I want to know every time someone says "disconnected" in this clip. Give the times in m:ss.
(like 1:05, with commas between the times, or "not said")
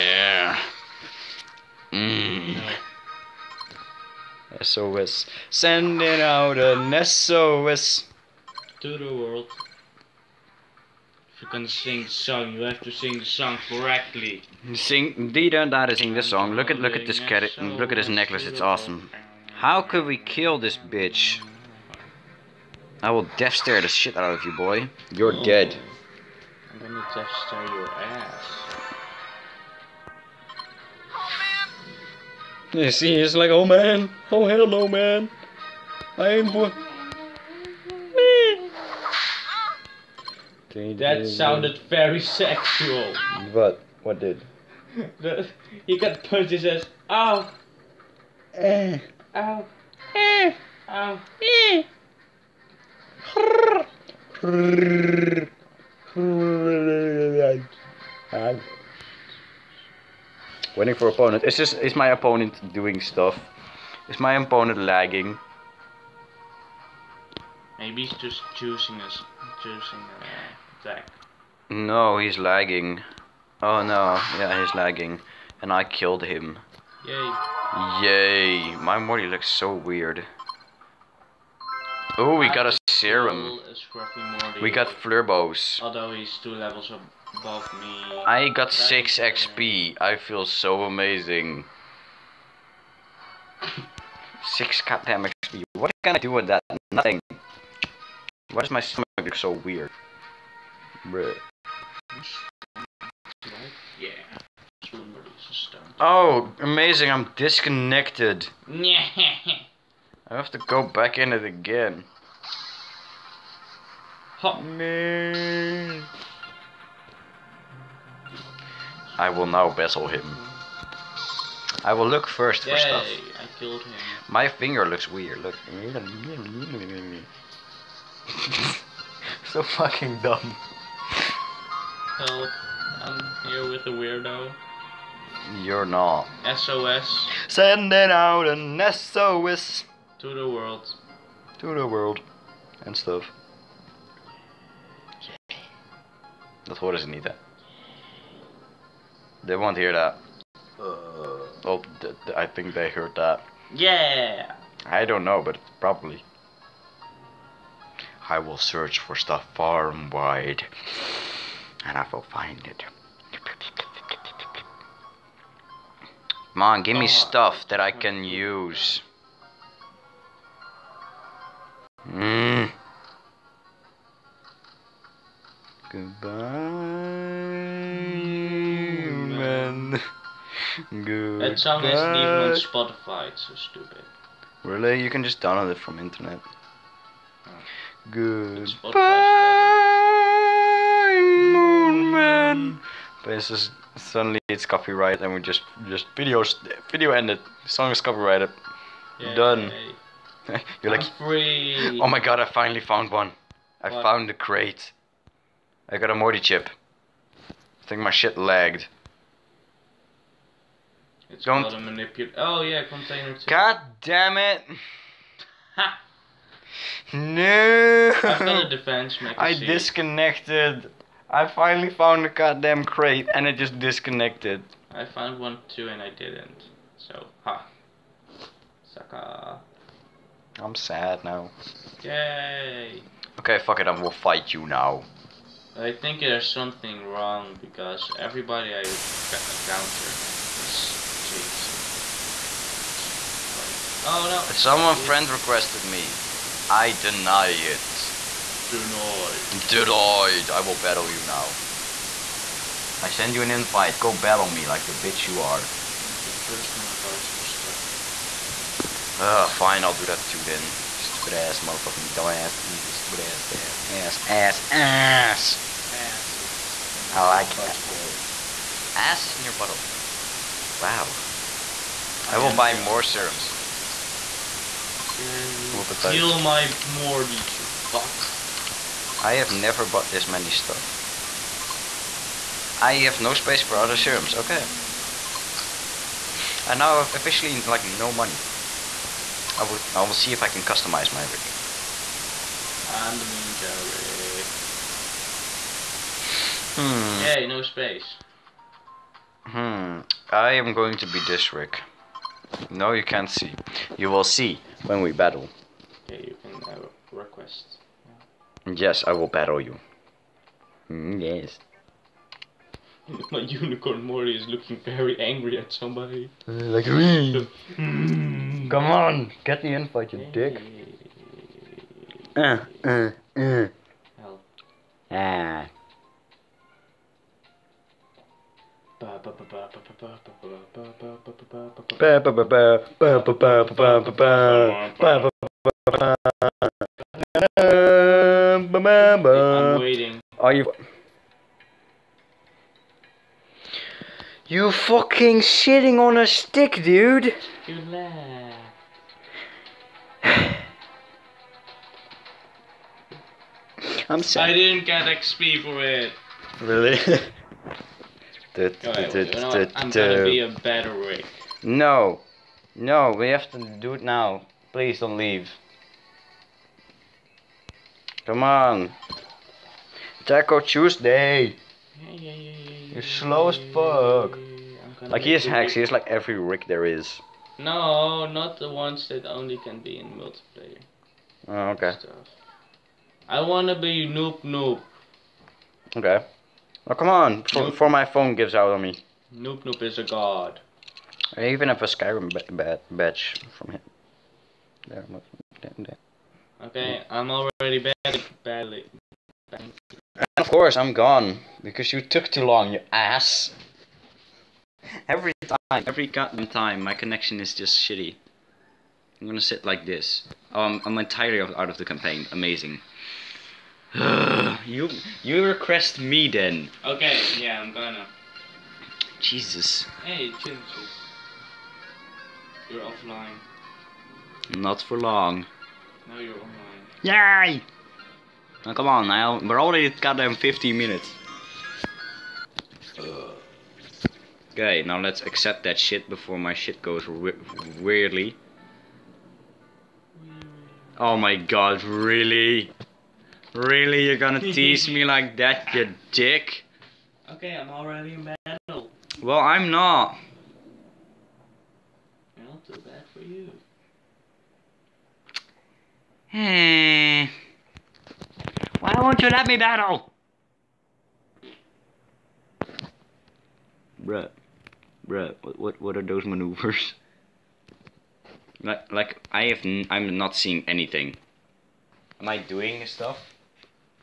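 1:47, 3:39, 3:43.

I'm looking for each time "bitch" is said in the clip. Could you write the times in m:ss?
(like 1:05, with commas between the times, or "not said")
0:20, 4:14.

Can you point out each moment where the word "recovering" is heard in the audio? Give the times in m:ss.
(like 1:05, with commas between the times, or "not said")
not said.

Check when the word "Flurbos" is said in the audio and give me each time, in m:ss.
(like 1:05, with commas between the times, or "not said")
1:24.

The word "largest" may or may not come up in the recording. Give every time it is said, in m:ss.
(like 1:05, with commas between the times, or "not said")
not said.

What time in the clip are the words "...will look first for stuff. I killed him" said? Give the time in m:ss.
2:01.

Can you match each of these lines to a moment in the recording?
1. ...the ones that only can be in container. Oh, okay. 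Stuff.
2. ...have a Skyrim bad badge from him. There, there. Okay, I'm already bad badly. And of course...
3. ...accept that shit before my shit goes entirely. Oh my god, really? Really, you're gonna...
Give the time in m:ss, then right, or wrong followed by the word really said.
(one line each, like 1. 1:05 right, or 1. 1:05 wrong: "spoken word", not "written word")
1. 6:18 wrong: "multiplayer", not "container"
2. 6:31 right
3. 7:15 wrong: "weirdly", not "entirely".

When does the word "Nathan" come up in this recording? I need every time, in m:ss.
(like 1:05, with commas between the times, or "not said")
not said.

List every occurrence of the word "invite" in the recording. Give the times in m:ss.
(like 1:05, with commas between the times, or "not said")
4:13, 5:19.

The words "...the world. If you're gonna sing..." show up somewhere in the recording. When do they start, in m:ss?
0:08.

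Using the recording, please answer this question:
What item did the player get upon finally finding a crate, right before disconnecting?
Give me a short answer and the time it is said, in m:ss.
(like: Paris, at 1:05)
Morty chip, at 3:25.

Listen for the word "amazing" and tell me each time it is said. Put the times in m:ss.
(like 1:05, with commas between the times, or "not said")
1:30, 1:46, 6:52.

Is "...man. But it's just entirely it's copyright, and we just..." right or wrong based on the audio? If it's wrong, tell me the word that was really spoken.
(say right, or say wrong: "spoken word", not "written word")
wrong: "suddenly", not "entirely".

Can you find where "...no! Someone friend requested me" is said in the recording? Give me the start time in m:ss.
4:04.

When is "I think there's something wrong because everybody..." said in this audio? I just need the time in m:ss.
3:55.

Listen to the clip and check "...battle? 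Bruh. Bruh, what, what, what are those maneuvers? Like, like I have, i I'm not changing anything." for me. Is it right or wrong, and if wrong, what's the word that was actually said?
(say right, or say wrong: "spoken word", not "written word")
wrong: "seeing", not "changing".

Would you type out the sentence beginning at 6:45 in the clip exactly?
Every time, every goddamn time, my connection is just shitty.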